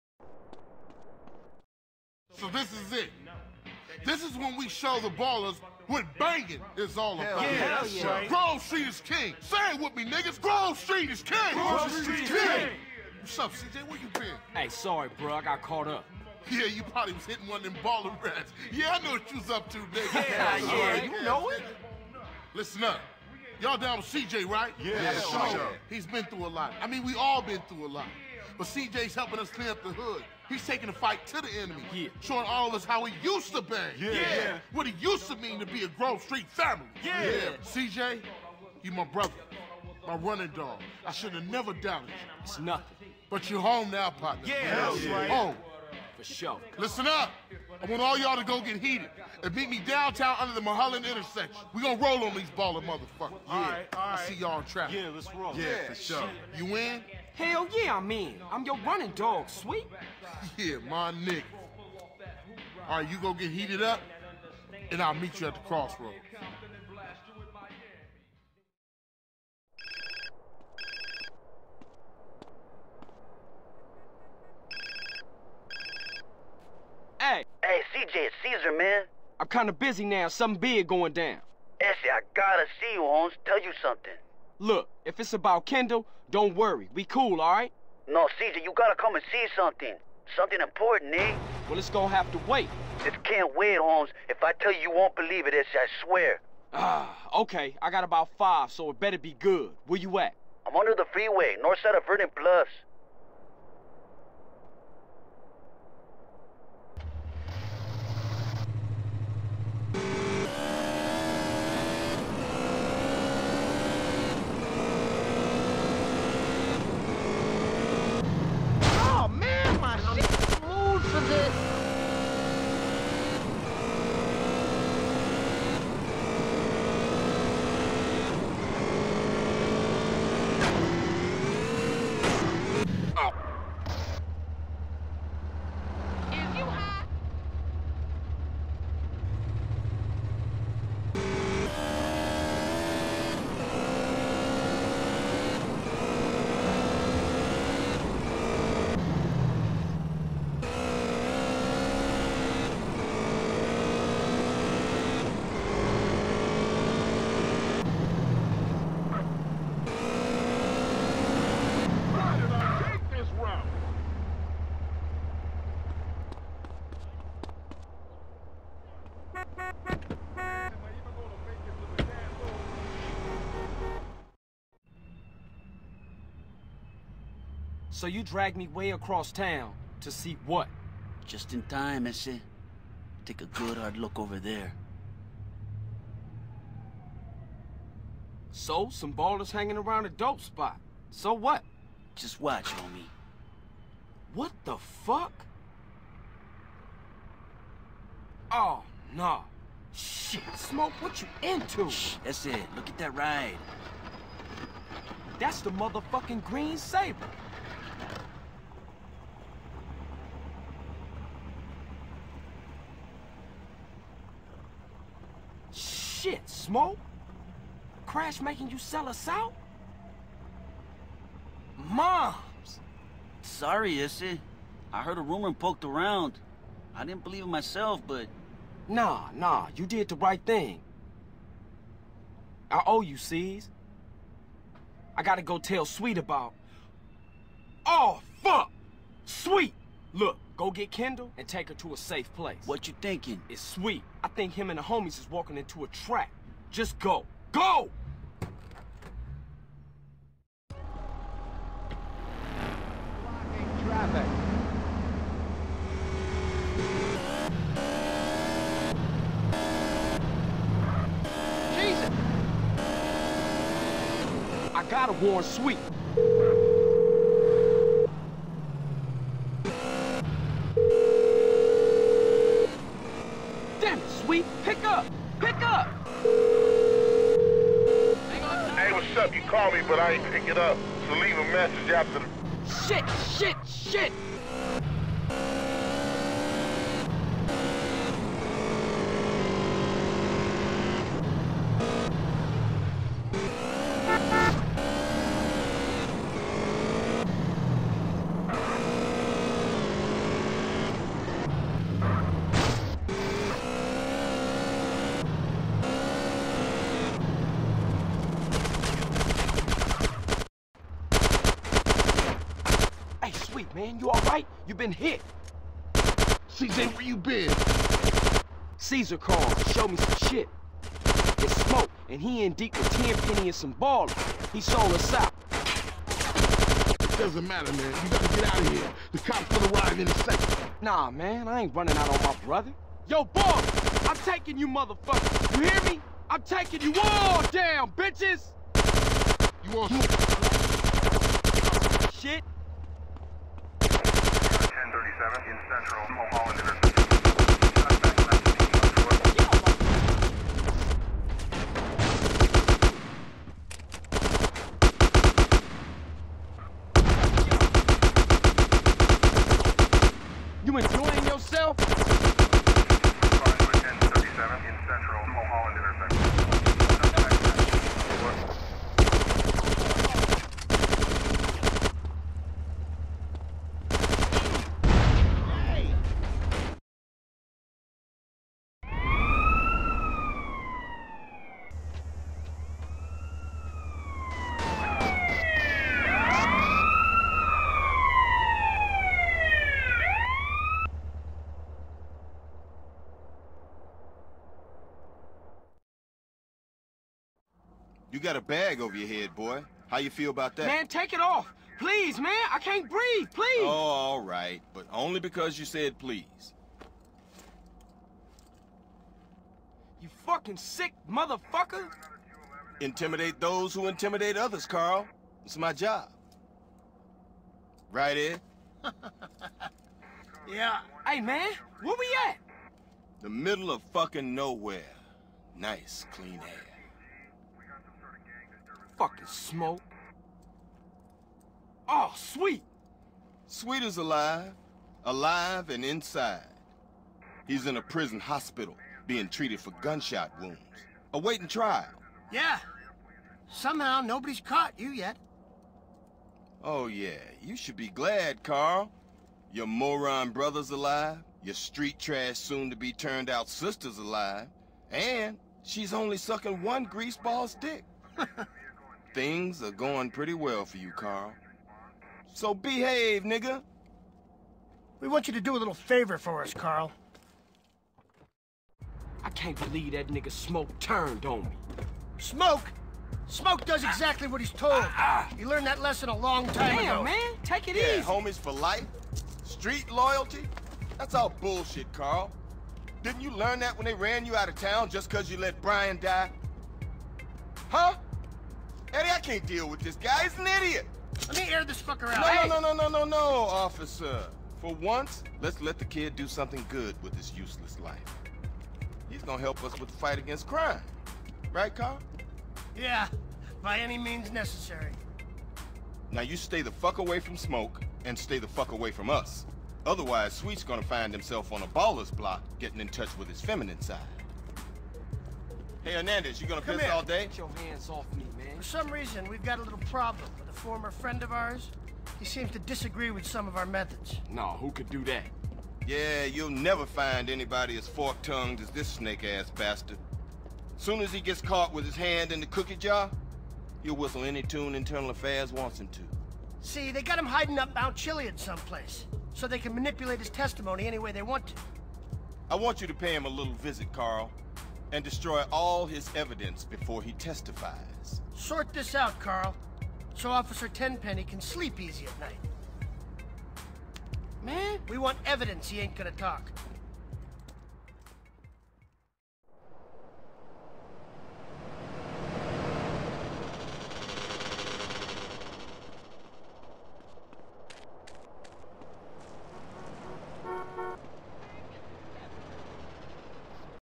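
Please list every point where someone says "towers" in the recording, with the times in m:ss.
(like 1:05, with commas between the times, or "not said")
not said.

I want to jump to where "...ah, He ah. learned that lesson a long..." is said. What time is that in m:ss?
7:54.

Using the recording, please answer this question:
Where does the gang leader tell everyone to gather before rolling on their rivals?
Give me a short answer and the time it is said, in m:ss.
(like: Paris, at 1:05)
Mulholland intersection, at 0:50.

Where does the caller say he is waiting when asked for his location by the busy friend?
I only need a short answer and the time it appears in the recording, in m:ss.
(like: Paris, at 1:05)
Vernon Bluffs, at 1:42.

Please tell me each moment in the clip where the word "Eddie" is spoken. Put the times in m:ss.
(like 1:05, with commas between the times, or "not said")
8:08.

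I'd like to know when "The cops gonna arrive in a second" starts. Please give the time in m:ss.
5:29.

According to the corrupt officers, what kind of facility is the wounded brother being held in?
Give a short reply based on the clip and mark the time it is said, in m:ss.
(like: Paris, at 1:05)
Prison hospital, at 7:17.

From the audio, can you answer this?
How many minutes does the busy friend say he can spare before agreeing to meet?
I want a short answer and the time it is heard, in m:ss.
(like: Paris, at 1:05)
5, at 1:38.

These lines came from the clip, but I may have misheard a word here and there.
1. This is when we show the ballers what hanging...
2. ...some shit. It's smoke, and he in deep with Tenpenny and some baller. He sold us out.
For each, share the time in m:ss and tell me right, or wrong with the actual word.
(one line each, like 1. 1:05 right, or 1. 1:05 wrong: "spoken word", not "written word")
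1. 0:04 wrong: "banging", not "hanging"
2. 5:19 right.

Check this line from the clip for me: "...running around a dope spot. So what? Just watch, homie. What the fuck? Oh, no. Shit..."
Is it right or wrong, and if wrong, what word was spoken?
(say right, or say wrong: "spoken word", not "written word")
wrong: "hanging", not "running".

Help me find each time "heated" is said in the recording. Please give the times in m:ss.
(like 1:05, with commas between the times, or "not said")
0:48, 1:03.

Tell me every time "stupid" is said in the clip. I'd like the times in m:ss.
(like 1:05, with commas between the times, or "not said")
not said.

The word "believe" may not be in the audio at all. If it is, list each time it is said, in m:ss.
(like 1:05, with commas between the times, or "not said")
1:35, 3:47, 7:49.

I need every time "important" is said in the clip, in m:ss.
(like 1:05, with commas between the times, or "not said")
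1:30.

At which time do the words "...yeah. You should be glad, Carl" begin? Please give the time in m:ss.
7:26.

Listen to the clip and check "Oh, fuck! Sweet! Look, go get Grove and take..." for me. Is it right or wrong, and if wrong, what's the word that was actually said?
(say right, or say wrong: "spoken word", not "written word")
wrong: "Kendl", not "Grove".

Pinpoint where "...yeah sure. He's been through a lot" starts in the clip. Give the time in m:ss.
0:24.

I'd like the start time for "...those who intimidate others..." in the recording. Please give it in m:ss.
6:53.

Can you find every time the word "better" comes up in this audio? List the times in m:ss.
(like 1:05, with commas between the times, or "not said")
1:38.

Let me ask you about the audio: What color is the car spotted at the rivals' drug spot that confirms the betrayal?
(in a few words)
Green.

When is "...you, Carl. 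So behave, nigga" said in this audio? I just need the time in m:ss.
7:40.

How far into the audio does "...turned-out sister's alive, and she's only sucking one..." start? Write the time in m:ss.
7:32.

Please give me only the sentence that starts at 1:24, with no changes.
Look, if it's about Kendl, don't worry.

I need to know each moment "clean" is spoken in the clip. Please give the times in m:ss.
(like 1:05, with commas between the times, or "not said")
0:29, 7:06.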